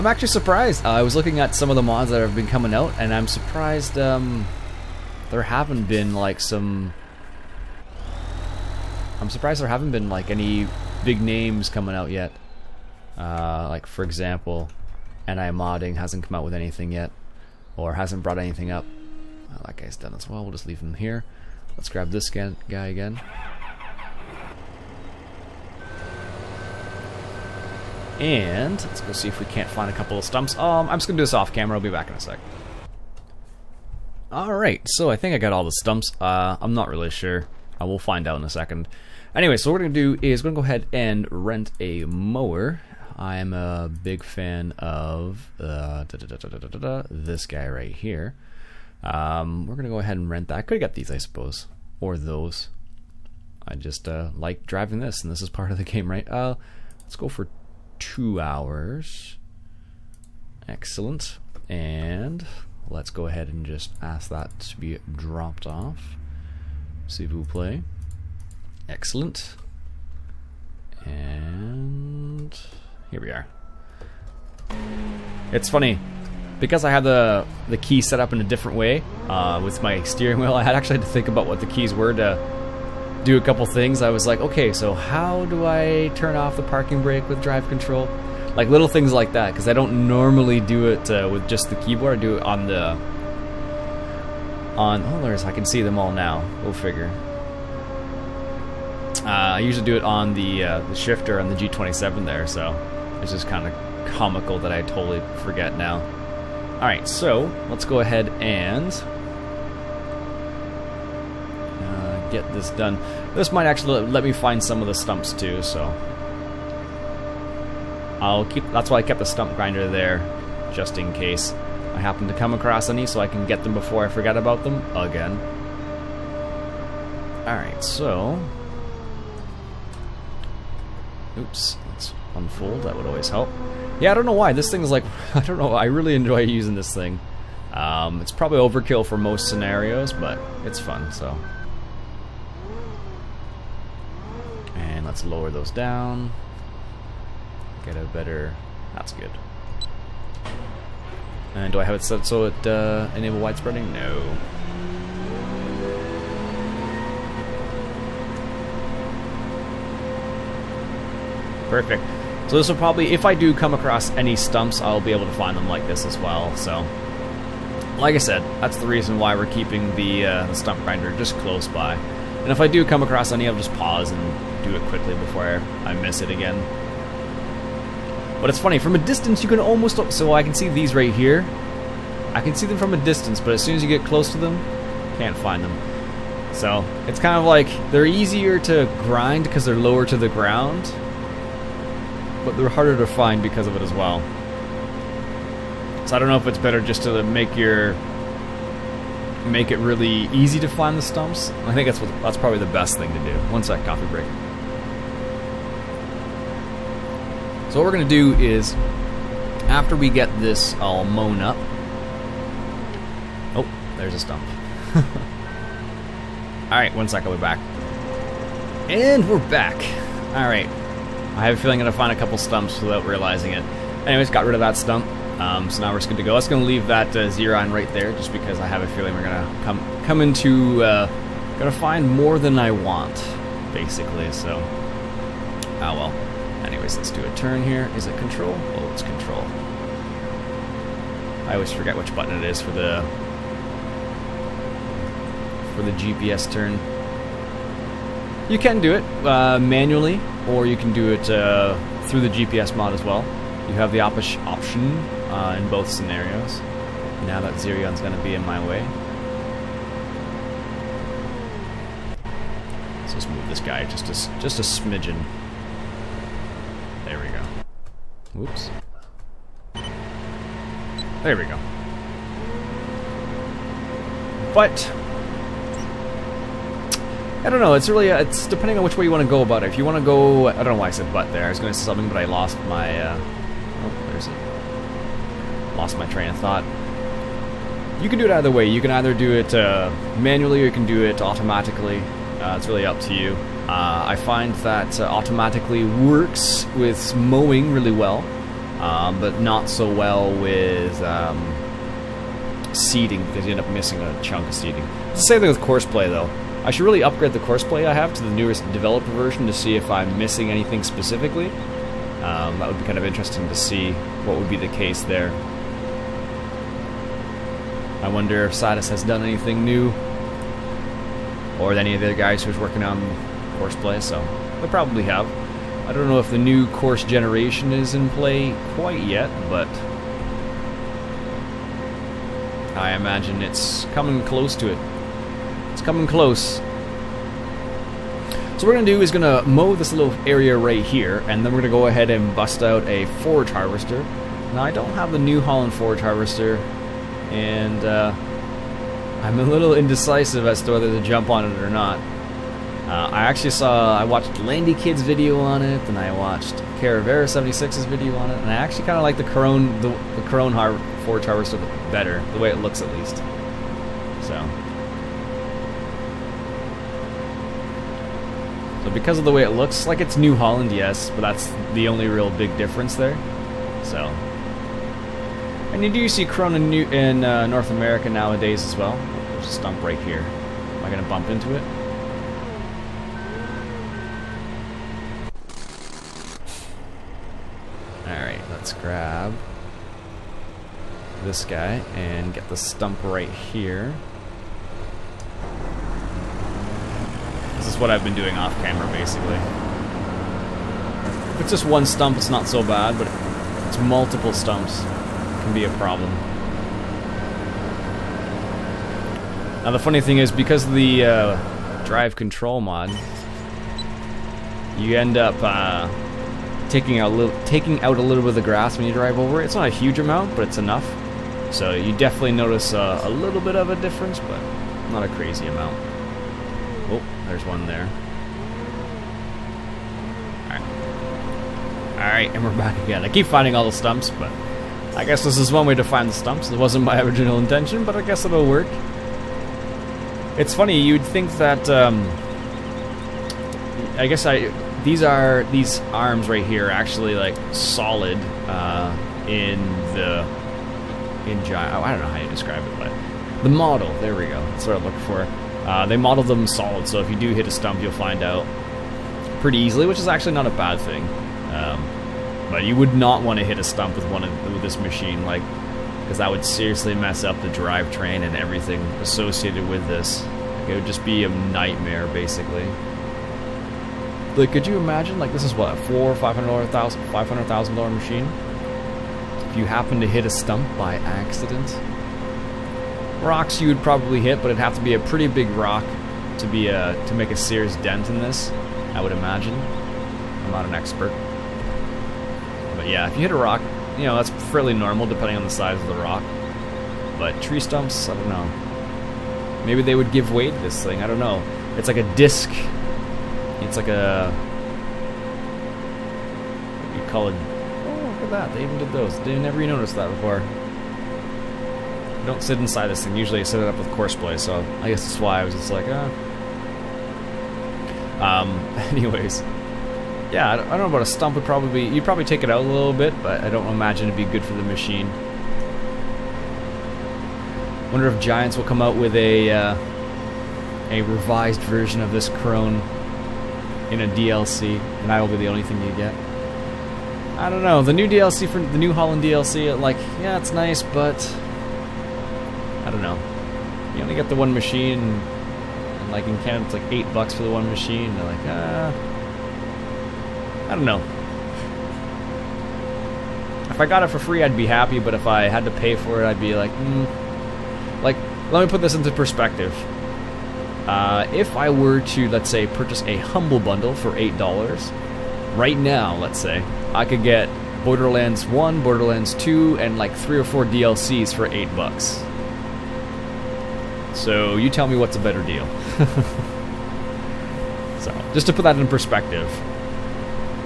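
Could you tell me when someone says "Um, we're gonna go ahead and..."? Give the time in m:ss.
0:49.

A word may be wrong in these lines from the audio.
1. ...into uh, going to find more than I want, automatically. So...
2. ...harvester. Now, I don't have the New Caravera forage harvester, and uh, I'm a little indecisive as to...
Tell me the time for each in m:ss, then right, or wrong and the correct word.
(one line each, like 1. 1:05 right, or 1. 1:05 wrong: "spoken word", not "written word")
1. 3:50 wrong: "basically", not "automatically"
2. 5:43 wrong: "Holland", not "Caravera".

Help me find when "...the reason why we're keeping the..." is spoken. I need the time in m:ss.
2:48.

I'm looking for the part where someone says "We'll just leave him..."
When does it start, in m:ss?
0:20.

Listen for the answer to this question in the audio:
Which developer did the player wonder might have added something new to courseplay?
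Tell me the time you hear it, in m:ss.
5:18.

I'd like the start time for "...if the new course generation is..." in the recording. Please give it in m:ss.
5:26.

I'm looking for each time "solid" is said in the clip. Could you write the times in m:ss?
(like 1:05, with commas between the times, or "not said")
7:27, 7:36.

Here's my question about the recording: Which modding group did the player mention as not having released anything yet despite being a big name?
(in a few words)
NI modding.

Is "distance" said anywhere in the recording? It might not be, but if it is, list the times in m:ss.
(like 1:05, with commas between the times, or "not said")
2:58, 3:03.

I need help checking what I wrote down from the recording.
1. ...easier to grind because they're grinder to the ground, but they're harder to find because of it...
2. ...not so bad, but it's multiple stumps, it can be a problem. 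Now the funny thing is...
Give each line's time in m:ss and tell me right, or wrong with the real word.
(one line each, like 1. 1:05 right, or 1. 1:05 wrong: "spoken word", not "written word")
1. 3:08 wrong: "lower", not "grinder"
2. 6:42 right.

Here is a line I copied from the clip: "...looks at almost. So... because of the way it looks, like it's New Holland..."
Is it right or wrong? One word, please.
wrong.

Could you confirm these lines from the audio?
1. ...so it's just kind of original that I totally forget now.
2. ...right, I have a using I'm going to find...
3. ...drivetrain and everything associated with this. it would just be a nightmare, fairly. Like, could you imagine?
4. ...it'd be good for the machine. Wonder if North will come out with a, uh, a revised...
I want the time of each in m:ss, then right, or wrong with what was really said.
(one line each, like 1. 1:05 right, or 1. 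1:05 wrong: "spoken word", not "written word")
1. 1:42 wrong: "comical", not "original"
2. 3:40 wrong: "feeling", not "using"
3. 7:47 wrong: "basically", not "fairly"
4. 8:44 wrong: "Giants", not "North".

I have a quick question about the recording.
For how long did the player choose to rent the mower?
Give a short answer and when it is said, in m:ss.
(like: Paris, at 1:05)
2 hours, at 0:57.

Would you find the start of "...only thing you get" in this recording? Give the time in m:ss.
8:55.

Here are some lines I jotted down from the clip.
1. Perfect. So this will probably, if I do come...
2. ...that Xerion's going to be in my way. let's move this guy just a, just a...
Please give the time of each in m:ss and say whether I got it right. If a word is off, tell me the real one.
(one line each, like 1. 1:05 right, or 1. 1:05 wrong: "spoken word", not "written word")
1. 2:41 right
2. 4:17 right.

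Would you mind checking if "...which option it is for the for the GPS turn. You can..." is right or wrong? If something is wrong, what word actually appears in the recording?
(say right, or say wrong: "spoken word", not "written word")
wrong: "button", not "option".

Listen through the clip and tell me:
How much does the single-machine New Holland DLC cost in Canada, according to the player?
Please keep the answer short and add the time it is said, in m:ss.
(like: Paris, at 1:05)
$8, at 9:06.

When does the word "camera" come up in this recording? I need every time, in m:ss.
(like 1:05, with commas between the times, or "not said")
0:31, 6:38.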